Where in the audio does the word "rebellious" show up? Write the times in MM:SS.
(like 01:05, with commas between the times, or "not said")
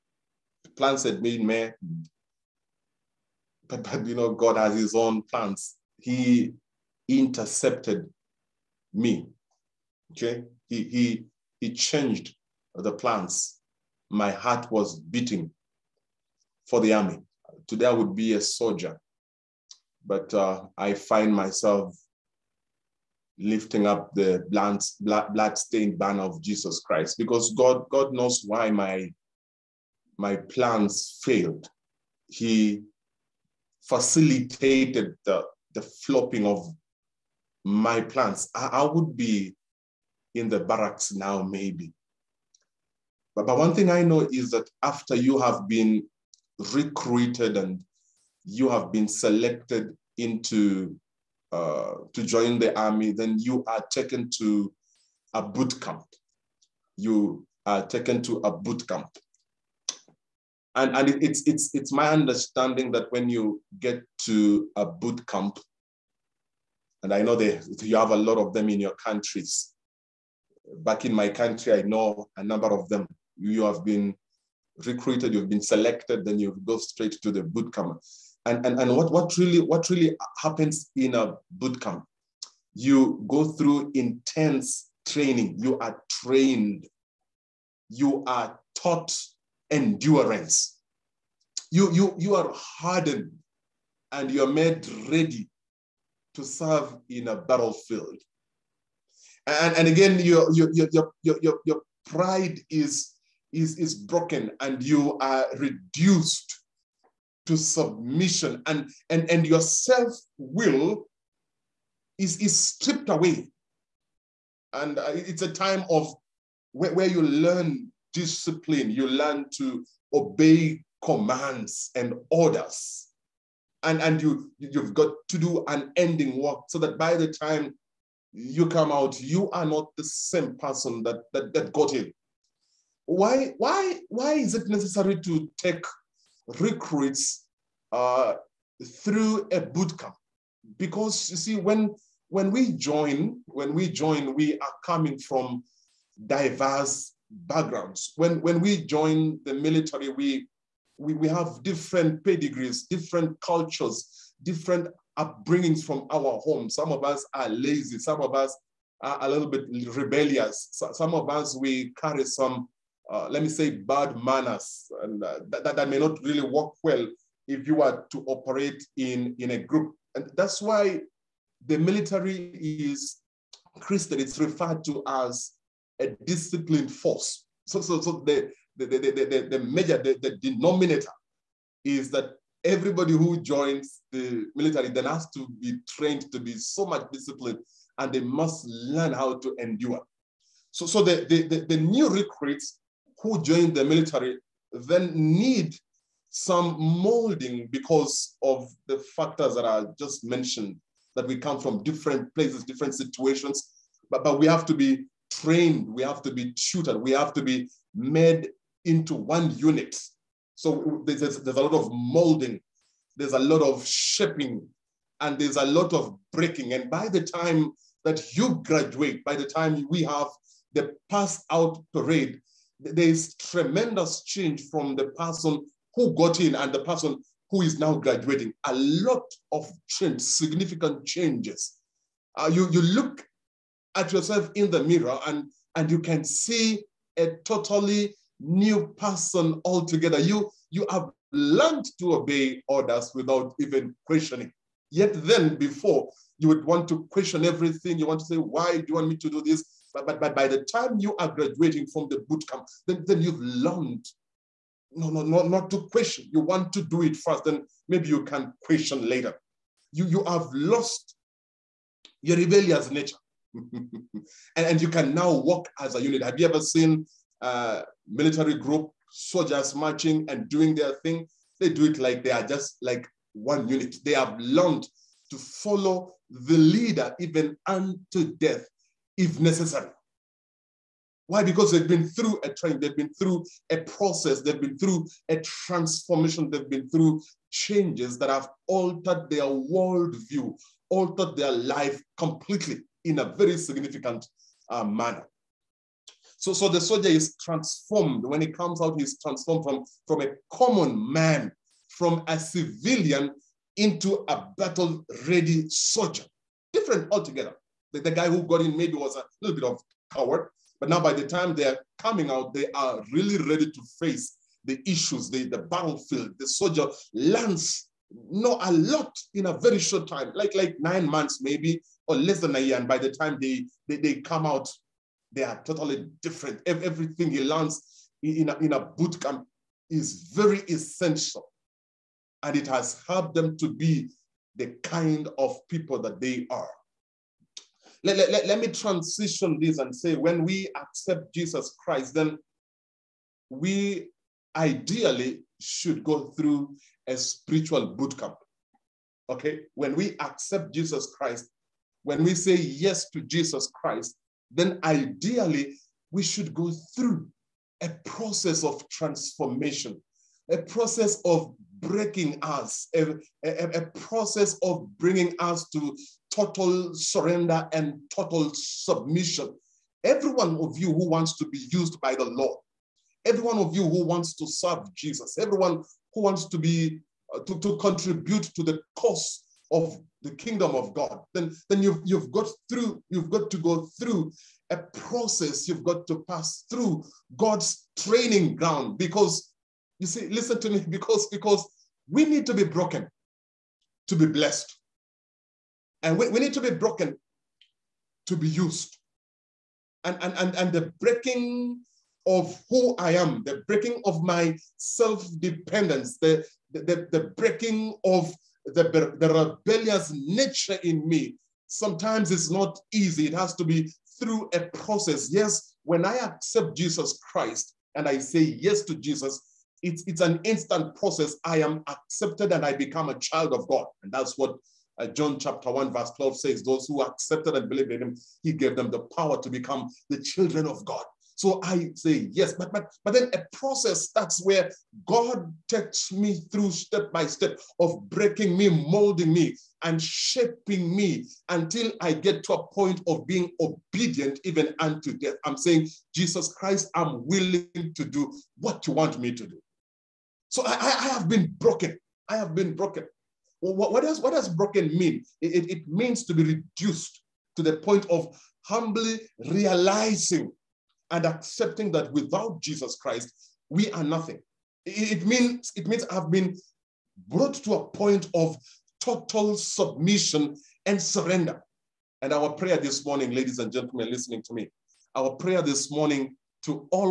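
02:39, 04:22, 06:49.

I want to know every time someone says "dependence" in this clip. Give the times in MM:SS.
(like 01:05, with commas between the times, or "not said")
06:45.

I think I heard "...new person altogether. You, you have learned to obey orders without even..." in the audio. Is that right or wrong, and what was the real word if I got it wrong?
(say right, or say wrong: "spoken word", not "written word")
right.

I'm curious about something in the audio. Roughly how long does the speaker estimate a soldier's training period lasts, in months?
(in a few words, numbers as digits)
9 months.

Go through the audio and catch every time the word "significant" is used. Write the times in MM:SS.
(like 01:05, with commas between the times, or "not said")
03:50, 04:53.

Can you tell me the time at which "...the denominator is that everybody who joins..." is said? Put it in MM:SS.
03:00.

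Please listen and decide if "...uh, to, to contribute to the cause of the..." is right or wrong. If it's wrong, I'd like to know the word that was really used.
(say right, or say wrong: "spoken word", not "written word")
right.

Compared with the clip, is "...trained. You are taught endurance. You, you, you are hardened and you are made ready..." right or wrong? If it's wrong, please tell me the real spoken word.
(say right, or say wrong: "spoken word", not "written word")
right.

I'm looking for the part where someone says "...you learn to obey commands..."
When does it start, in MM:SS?
01:58.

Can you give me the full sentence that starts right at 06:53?
It has to be through a process.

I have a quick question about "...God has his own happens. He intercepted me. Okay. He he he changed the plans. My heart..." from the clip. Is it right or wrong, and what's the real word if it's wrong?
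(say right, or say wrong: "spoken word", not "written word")
wrong: "plans", not "happens".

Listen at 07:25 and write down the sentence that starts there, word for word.
I'm saying, Jesus Christ, I'm willing to do what you want me to do.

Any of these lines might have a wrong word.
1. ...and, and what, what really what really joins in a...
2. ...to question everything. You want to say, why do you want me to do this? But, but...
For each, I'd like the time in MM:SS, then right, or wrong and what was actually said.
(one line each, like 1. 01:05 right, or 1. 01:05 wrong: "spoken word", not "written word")
1. 01:18 wrong: "happens", not "joins"
2. 04:06 right.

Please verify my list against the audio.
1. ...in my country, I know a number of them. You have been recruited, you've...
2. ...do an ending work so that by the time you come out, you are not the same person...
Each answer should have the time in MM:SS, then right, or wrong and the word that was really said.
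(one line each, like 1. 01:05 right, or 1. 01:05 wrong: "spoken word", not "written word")
1. 01:11 right
2. 02:05 right.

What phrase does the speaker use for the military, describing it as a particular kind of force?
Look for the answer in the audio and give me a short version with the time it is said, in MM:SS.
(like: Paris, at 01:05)
disciplined force, at 02:56.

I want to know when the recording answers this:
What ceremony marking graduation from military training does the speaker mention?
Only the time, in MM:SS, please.
03:41.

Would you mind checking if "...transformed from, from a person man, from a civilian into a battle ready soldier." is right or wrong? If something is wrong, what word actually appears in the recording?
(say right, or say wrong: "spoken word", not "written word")
wrong: "common", not "person".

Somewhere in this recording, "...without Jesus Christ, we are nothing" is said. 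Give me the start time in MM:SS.
07:42.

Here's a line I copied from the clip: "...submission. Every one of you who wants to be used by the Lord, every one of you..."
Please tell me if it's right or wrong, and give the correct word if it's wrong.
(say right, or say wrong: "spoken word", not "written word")
right.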